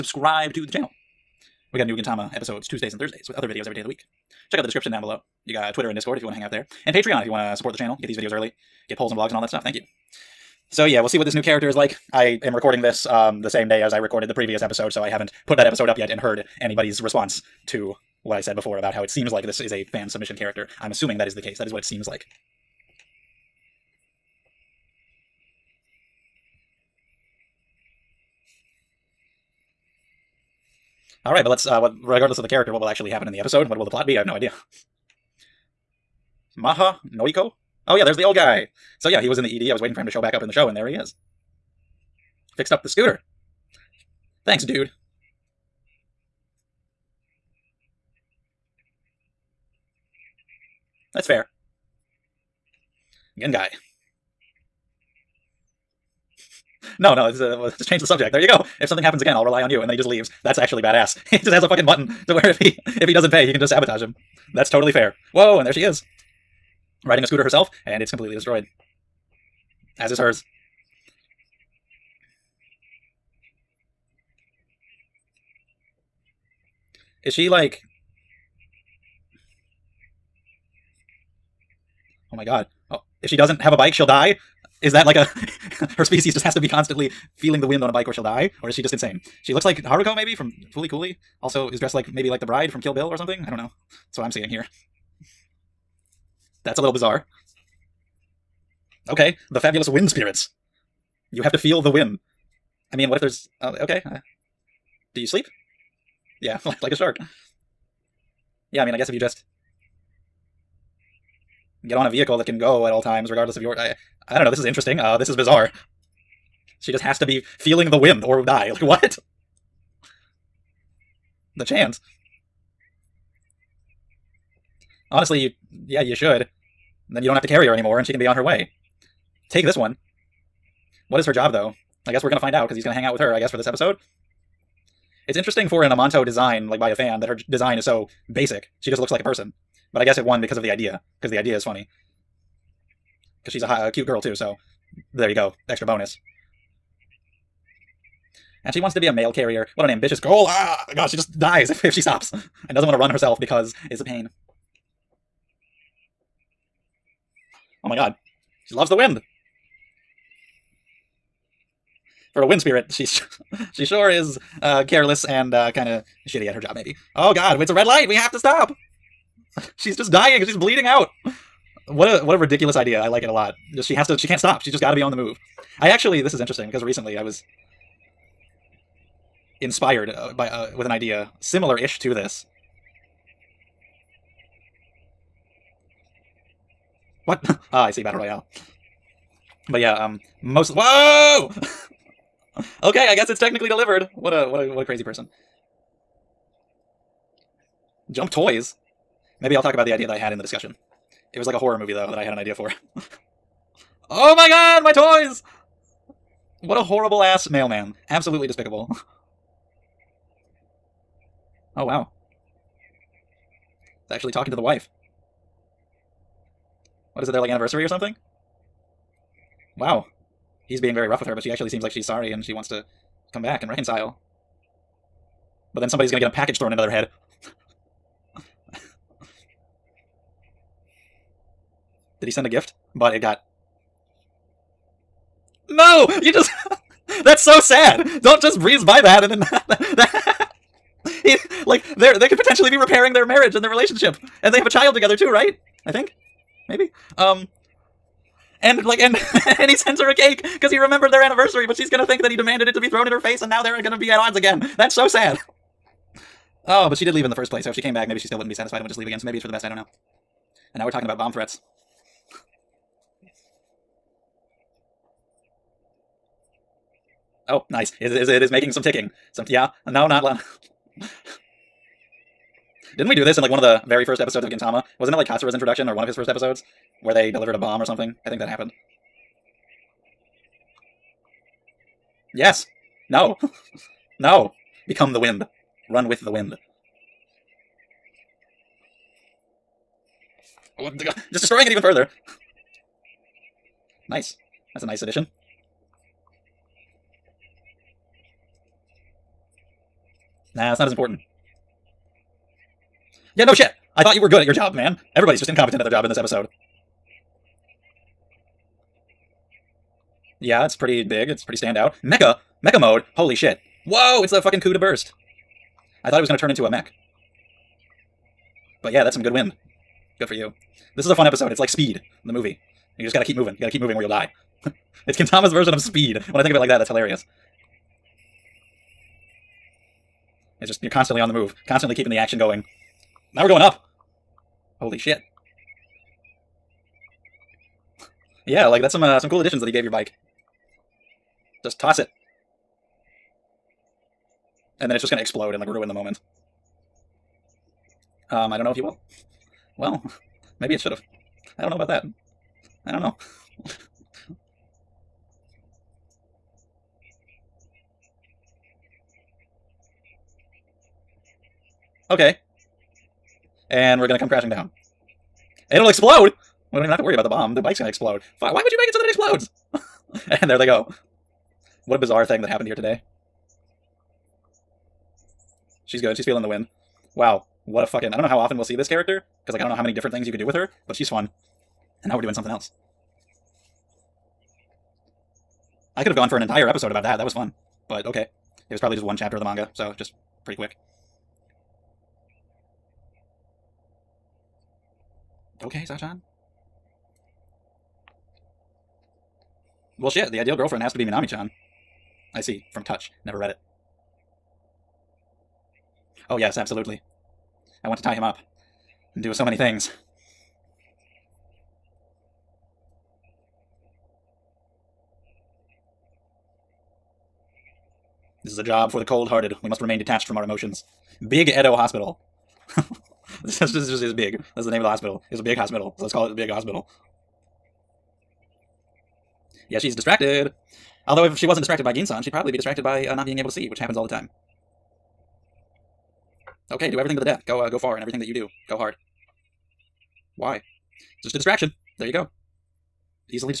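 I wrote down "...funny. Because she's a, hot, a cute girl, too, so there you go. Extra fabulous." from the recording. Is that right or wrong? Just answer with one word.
wrong.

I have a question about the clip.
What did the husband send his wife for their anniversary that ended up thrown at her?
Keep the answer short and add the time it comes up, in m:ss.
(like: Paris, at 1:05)
A cake, at 4:10.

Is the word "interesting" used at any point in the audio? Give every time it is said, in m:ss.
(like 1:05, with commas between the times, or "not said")
1:54, 2:15, 2:56.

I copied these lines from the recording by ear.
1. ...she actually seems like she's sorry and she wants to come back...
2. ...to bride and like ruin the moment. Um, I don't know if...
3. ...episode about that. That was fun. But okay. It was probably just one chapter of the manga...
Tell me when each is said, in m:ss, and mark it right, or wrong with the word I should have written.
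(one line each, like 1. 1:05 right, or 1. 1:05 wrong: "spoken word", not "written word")
1. 3:41 right
2. 5:45 wrong: "explode", not "bride"
3. 6:26 right.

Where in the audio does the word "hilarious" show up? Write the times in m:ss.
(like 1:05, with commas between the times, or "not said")
5:26.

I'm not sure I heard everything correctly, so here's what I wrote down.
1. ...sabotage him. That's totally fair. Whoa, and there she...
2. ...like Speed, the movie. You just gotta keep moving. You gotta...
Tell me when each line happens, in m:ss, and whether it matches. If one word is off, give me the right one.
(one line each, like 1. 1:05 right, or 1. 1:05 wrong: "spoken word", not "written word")
1. 1:03 right
2. 5:21 right.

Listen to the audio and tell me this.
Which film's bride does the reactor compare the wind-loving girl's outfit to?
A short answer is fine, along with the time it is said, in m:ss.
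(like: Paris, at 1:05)
Kill Bill, at 1:32.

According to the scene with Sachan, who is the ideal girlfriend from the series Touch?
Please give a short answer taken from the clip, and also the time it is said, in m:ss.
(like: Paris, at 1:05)
Minami chan, at 6:41.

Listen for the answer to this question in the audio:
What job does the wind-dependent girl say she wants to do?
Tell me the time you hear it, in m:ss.
2:29.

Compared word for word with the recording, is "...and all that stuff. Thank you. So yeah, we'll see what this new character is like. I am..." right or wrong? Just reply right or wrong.
right.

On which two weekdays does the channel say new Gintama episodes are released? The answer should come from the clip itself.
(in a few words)
Tuesdays and Thursdays.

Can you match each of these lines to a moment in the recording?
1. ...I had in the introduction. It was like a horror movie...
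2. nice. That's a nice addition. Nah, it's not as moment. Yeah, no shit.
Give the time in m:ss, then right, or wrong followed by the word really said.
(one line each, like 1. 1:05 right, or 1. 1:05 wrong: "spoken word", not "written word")
1. 3:20 wrong: "discussion", not "introduction"
2. 4:54 wrong: "important", not "moment".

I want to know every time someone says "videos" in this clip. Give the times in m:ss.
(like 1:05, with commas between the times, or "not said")
0:03, 0:08.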